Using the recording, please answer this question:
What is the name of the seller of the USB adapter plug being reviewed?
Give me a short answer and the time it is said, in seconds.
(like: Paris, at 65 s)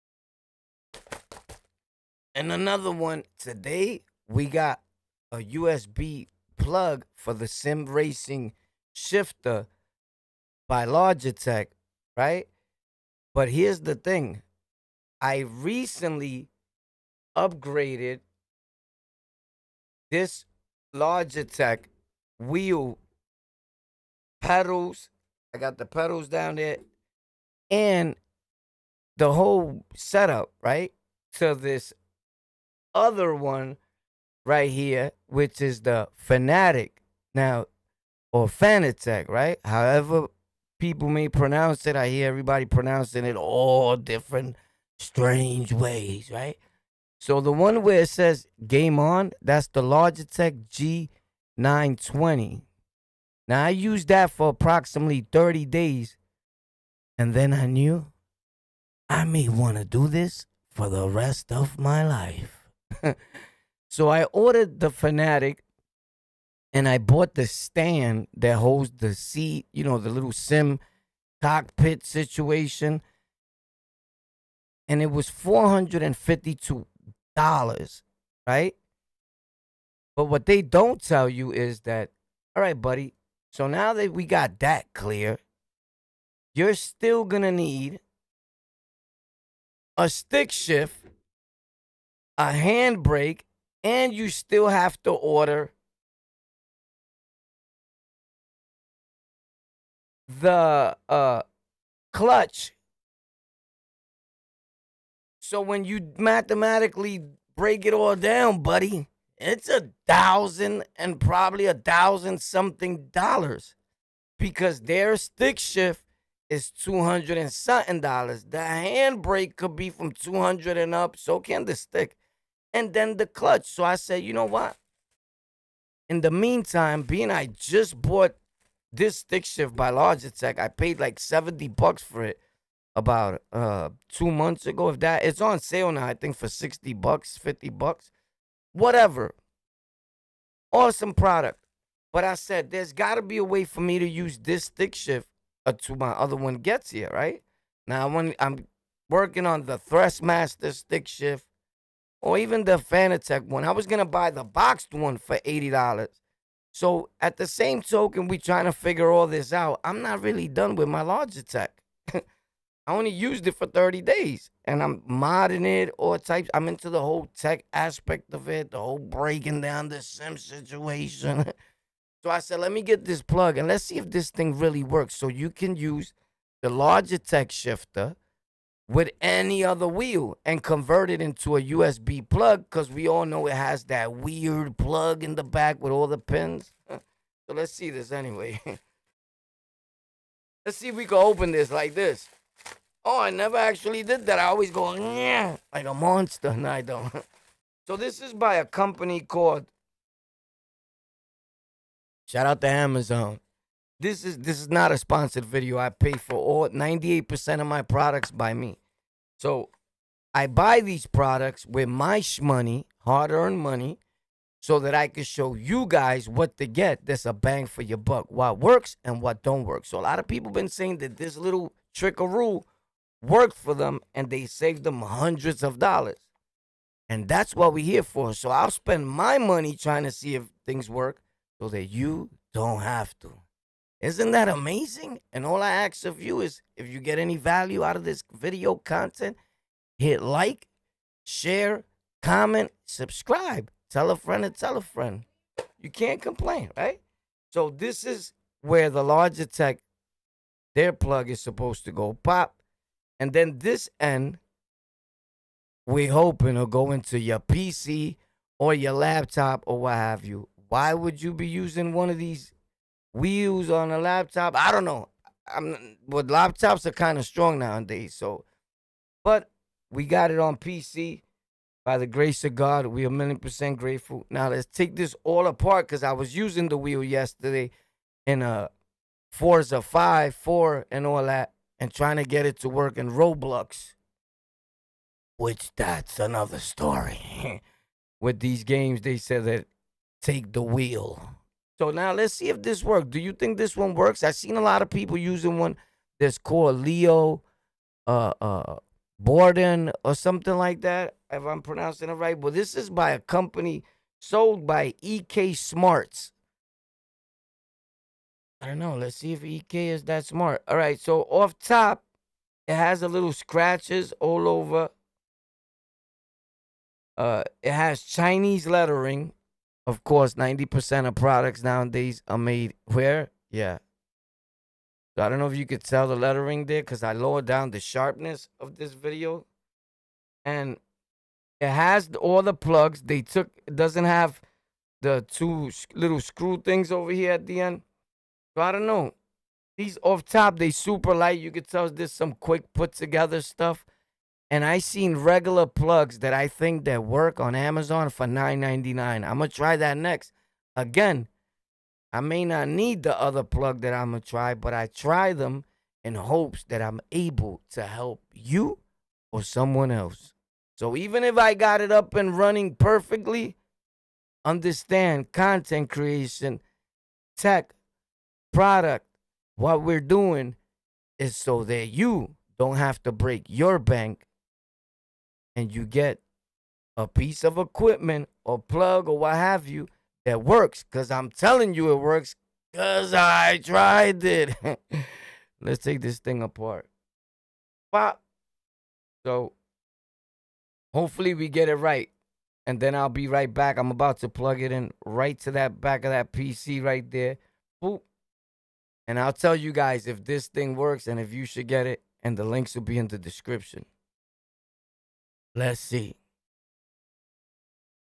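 EK Smarts, at 305 s.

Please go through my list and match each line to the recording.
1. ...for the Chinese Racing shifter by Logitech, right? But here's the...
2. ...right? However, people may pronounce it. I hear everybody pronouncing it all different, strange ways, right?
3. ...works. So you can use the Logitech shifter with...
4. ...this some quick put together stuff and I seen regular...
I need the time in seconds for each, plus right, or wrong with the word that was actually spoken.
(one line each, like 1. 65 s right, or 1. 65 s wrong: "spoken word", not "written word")
1. 7 s wrong: "Sim", not "Chinese"
2. 39 s right
3. 174 s right
4. 341 s right.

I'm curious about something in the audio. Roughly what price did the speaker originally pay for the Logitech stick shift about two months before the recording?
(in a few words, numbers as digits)
$70.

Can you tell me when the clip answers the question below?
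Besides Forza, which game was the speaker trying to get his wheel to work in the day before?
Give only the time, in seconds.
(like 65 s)
283 s.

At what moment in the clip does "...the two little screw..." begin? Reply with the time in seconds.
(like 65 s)
335 s.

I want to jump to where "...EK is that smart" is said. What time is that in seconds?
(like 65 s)
309 s.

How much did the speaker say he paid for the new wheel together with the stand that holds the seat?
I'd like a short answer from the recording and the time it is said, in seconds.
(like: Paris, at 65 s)
$452, at 75 s.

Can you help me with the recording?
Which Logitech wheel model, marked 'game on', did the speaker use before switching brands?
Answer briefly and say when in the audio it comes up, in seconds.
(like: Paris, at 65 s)
G920, at 51 s.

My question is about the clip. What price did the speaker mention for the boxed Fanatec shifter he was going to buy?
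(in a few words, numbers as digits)
$80.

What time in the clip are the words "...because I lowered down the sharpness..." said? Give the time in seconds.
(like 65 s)
326 s.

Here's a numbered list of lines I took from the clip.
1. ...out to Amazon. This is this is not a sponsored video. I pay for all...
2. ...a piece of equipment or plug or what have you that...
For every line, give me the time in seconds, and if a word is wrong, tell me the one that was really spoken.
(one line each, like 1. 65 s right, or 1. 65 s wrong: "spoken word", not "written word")
1. 202 s right
2. 376 s right.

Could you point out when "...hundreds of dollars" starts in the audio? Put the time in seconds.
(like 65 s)
225 s.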